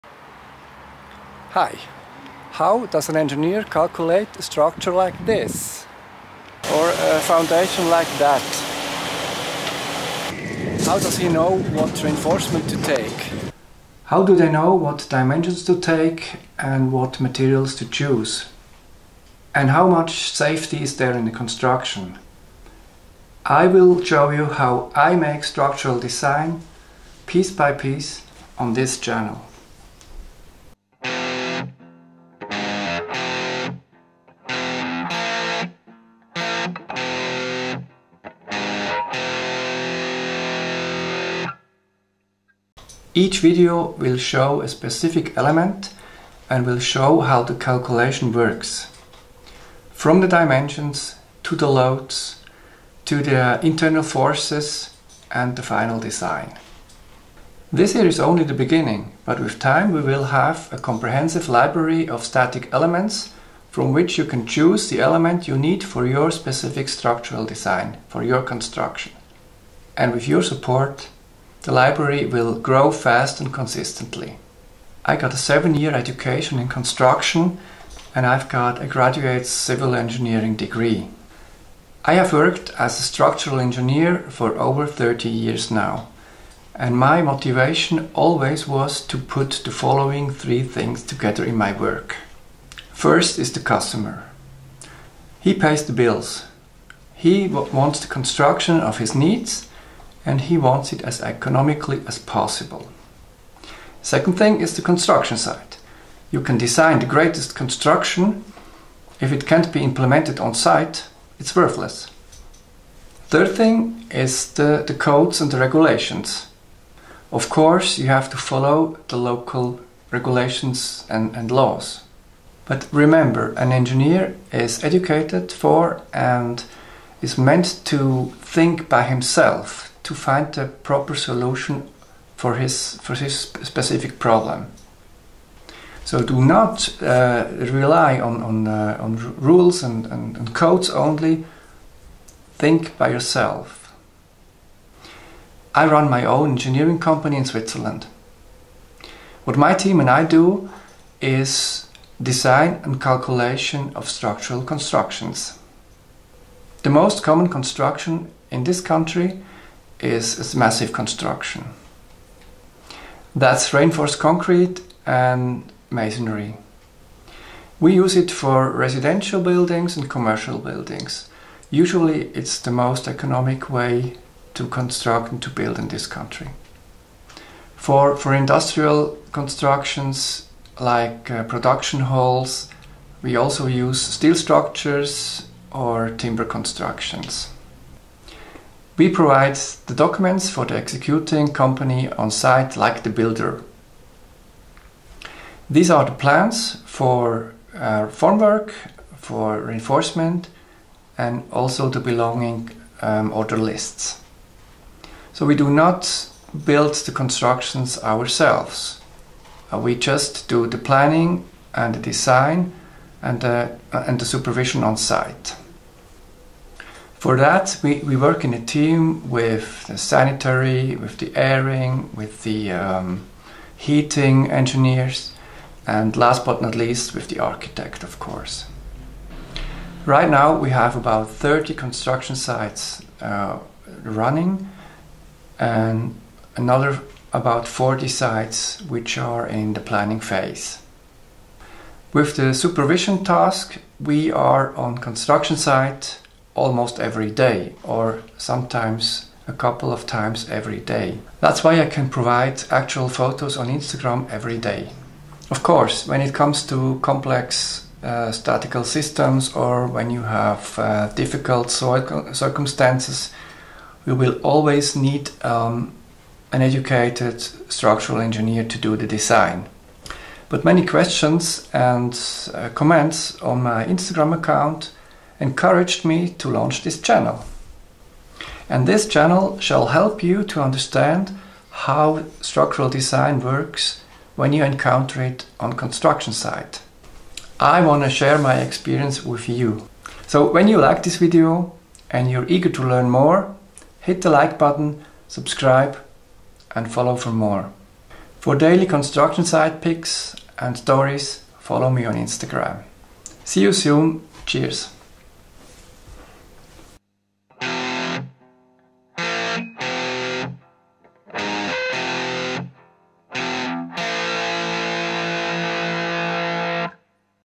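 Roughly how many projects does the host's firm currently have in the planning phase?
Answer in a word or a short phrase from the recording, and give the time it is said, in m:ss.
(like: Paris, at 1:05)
about 40, at 3:57.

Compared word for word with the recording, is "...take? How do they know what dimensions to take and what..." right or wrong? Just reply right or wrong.
right.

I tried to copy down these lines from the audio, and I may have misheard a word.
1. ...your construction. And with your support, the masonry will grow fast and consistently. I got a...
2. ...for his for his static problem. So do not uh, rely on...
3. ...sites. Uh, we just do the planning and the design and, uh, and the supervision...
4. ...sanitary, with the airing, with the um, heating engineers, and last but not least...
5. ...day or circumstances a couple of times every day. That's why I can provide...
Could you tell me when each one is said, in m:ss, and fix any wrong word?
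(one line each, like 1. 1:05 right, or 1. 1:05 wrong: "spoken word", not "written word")
1. 1:08 wrong: "library", not "masonry"
2. 2:12 wrong: "specific", not "static"
3. 3:28 wrong: "ourselves", not "sites"
4. 3:39 right
5. 4:07 wrong: "sometimes", not "circumstances".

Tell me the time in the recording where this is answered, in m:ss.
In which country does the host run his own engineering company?
2:27.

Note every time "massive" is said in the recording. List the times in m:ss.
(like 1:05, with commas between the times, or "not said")
2:40.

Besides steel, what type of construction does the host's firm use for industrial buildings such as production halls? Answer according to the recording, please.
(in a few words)
timber constructions.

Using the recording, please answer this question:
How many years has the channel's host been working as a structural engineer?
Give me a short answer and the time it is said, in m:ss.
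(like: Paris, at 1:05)
over 30 years, at 1:24.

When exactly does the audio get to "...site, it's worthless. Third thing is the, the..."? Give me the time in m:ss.
1:50.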